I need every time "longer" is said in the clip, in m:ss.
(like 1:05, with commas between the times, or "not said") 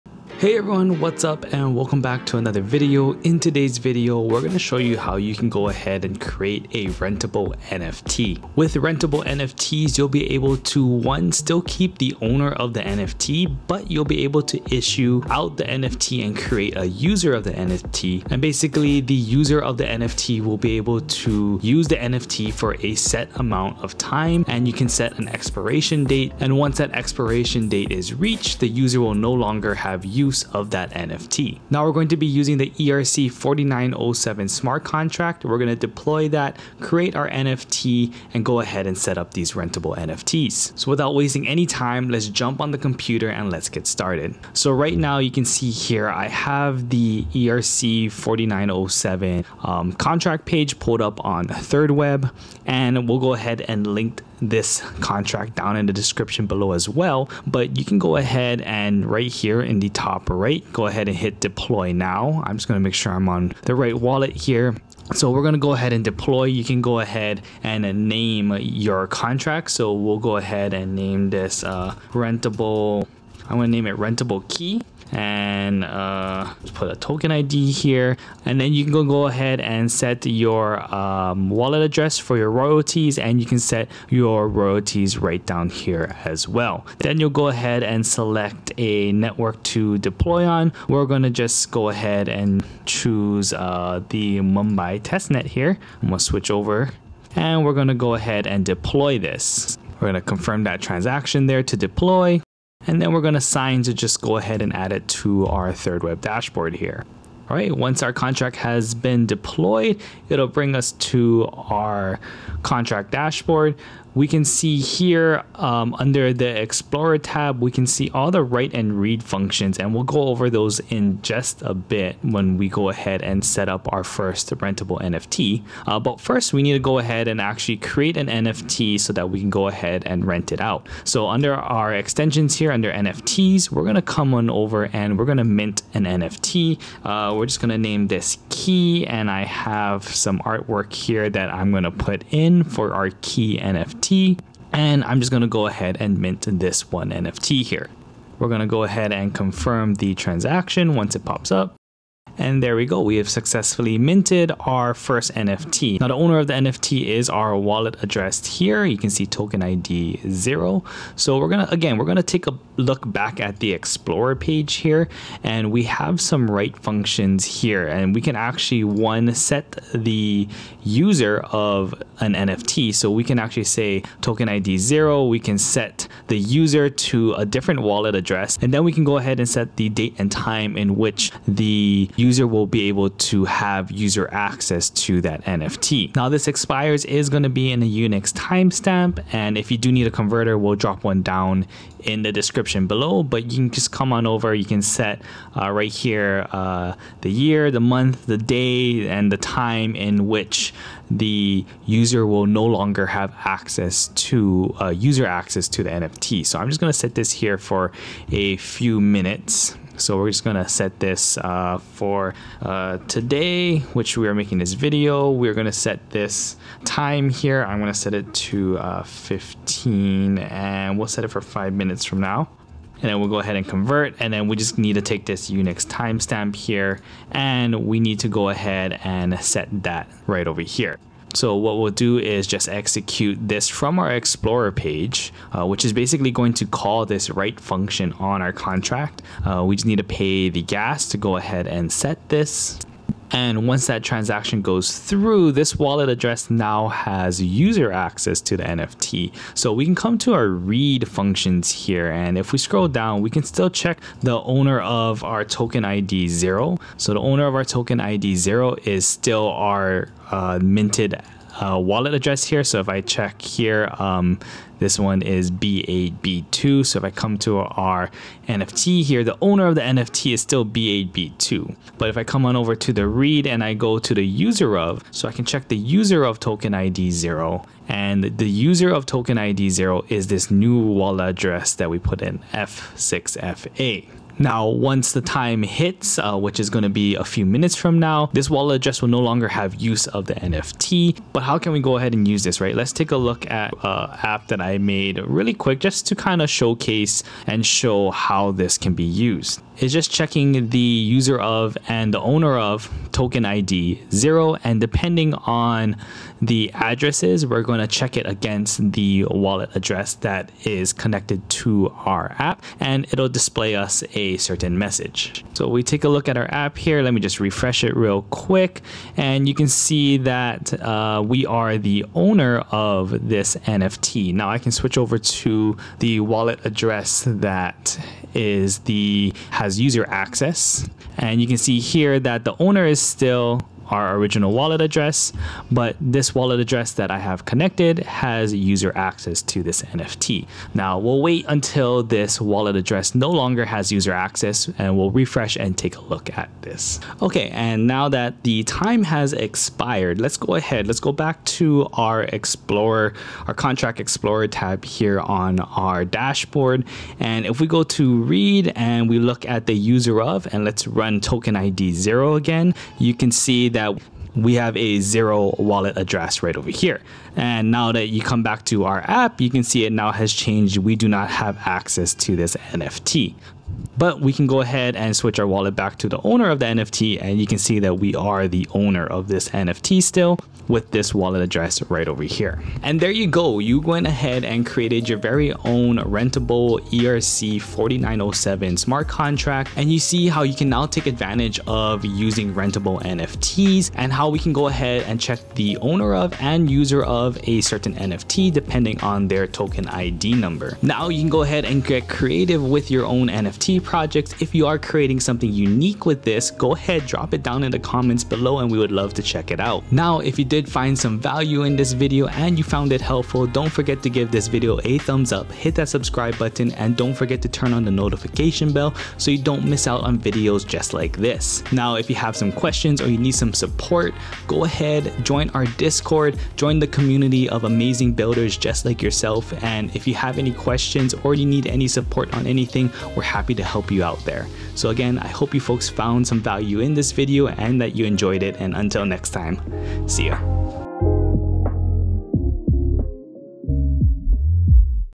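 0:29, 3:22, 4:49, 5:43.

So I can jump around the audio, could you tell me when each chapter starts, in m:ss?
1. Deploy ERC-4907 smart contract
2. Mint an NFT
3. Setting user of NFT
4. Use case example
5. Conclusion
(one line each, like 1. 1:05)
1. 0:44
2. 2:10
3. 2:36
4. 4:52
5. 6:22.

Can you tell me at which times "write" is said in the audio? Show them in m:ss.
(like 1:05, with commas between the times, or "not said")
1:58, 2:46, 3:57.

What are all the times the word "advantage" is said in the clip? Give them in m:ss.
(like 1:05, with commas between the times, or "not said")
6:31.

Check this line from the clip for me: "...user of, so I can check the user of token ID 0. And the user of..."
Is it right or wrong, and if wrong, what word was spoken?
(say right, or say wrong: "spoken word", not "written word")
right.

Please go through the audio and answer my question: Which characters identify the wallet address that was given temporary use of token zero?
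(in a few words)
F6FA.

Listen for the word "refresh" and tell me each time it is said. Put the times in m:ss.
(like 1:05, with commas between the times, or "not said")
5:17, 5:45.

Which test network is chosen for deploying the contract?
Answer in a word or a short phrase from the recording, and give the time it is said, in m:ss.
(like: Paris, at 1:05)
Mumbai testnet, at 1:34.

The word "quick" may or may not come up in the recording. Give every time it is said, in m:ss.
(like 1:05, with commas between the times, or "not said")
4:55, 5:18.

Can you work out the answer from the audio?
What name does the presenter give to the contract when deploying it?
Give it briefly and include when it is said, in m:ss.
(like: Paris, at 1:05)
rentable key, at 1:13.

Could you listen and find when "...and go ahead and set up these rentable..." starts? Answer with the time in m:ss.
0:38.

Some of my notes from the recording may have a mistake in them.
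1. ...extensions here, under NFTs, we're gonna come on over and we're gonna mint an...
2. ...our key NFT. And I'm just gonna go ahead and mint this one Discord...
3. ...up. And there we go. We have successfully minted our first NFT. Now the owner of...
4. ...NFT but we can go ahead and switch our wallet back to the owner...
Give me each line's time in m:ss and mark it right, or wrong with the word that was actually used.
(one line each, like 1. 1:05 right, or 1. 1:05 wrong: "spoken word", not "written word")
1. 2:11 right
2. 2:22 wrong: "NFT", not "Discord"
3. 2:31 right
4. 6:12 right.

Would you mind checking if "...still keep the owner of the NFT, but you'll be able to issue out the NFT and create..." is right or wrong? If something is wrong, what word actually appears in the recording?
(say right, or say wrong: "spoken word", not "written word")
right.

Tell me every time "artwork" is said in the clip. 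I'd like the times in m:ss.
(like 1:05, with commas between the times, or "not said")
2:20.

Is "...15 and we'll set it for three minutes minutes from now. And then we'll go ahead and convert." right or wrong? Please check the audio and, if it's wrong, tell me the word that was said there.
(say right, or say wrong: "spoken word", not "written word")
wrong: "five", not "three".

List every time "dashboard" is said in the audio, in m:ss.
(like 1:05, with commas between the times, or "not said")
1:46, 1:53, 5:56.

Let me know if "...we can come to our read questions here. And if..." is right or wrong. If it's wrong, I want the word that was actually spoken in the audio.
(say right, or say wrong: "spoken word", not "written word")
wrong: "functions", not "questions".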